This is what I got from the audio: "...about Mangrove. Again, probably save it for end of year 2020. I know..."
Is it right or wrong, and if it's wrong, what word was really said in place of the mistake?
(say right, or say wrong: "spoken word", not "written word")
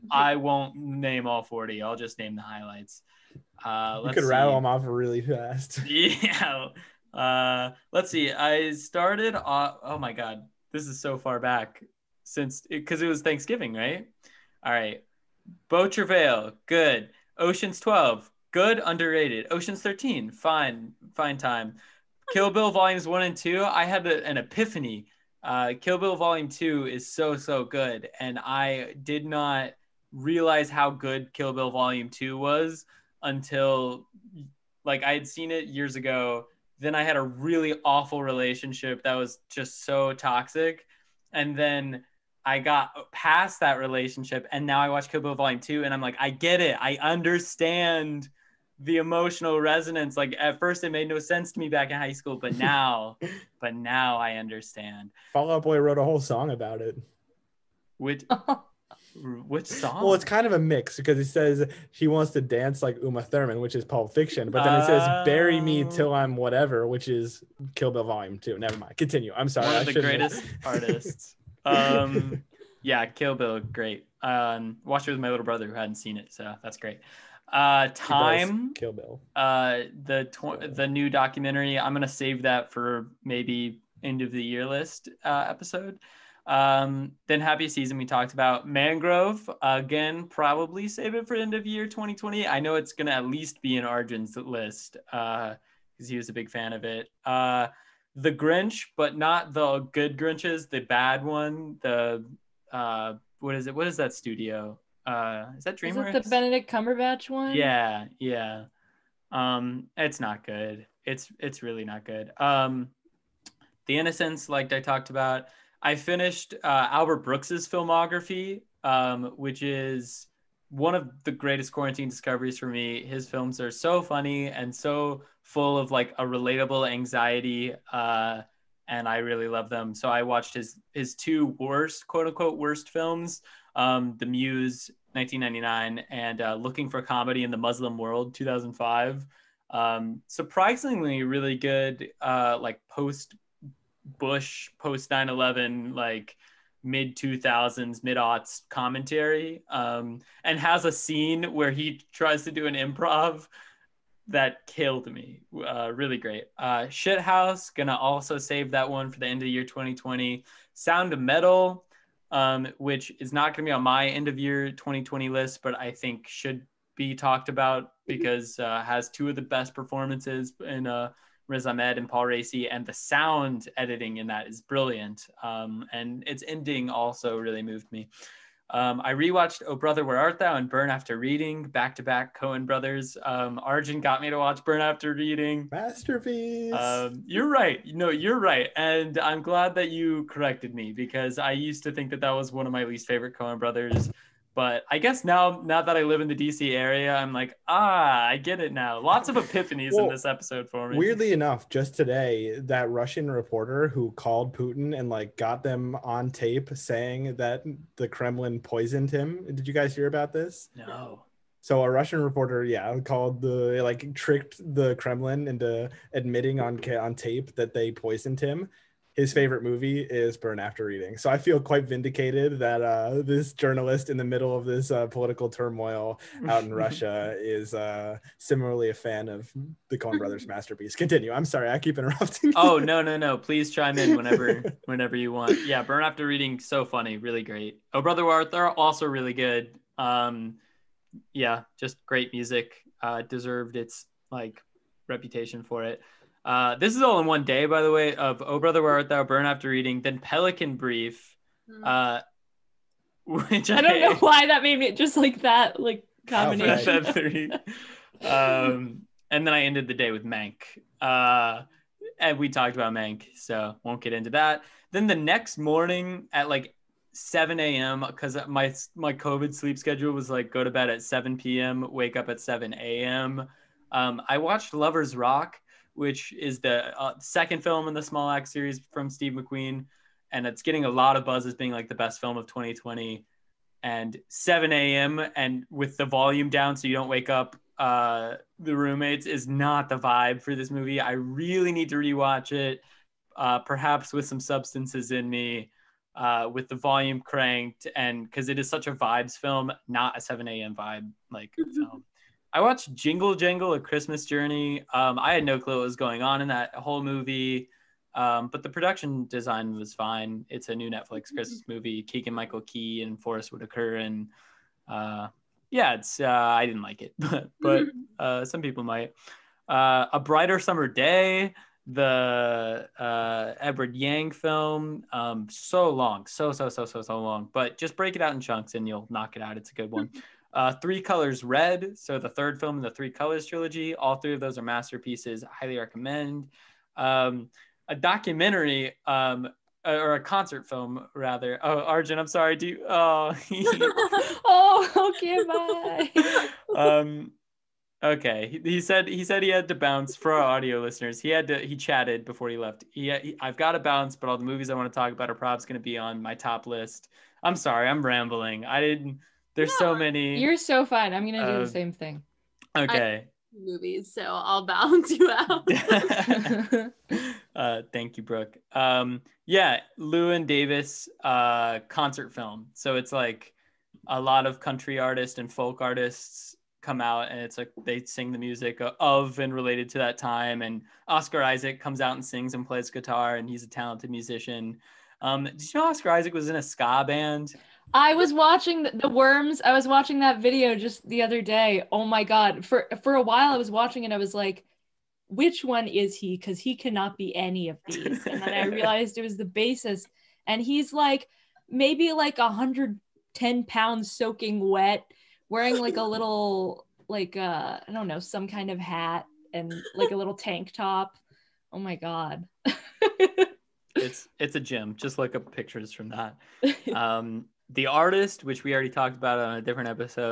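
right.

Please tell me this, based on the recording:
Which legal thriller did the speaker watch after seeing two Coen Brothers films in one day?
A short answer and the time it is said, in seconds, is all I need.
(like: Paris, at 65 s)
Pelican Brief, at 250 s.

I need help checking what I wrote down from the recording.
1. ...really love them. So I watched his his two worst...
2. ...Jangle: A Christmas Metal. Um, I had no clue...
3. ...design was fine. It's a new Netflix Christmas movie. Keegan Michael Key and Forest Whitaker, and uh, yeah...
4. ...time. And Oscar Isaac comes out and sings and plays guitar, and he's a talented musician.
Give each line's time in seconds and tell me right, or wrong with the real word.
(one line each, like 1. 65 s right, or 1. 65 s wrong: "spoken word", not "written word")
1. 129 s right
2. 303 s wrong: "Journey", not "Metal"
3. 309 s right
4. 380 s right.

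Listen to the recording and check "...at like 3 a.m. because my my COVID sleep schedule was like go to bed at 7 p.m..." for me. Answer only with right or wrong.
wrong.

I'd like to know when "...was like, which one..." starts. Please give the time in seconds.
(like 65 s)
394 s.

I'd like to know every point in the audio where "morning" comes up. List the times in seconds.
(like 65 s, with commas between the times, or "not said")
265 s.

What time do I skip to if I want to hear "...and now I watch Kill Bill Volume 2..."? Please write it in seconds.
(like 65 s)
44 s.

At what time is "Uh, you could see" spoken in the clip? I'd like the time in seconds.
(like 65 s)
3 s.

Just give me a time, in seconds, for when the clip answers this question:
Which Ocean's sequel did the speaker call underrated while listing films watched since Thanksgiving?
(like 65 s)
17 s.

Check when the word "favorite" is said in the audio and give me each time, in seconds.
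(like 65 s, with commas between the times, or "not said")
193 s, 219 s.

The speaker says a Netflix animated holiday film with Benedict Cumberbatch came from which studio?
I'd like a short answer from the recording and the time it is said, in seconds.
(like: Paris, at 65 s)
DreamWorks, at 105 s.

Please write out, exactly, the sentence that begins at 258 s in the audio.
um, and then I ended the day with Mank.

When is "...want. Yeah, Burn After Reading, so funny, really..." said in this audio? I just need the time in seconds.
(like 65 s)
235 s.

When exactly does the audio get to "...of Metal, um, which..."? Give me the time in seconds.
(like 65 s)
161 s.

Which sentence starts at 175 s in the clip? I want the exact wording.
Um, and its ending also really moved me.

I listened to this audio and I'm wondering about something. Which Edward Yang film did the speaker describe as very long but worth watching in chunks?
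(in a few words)
A Brighter Summer Day.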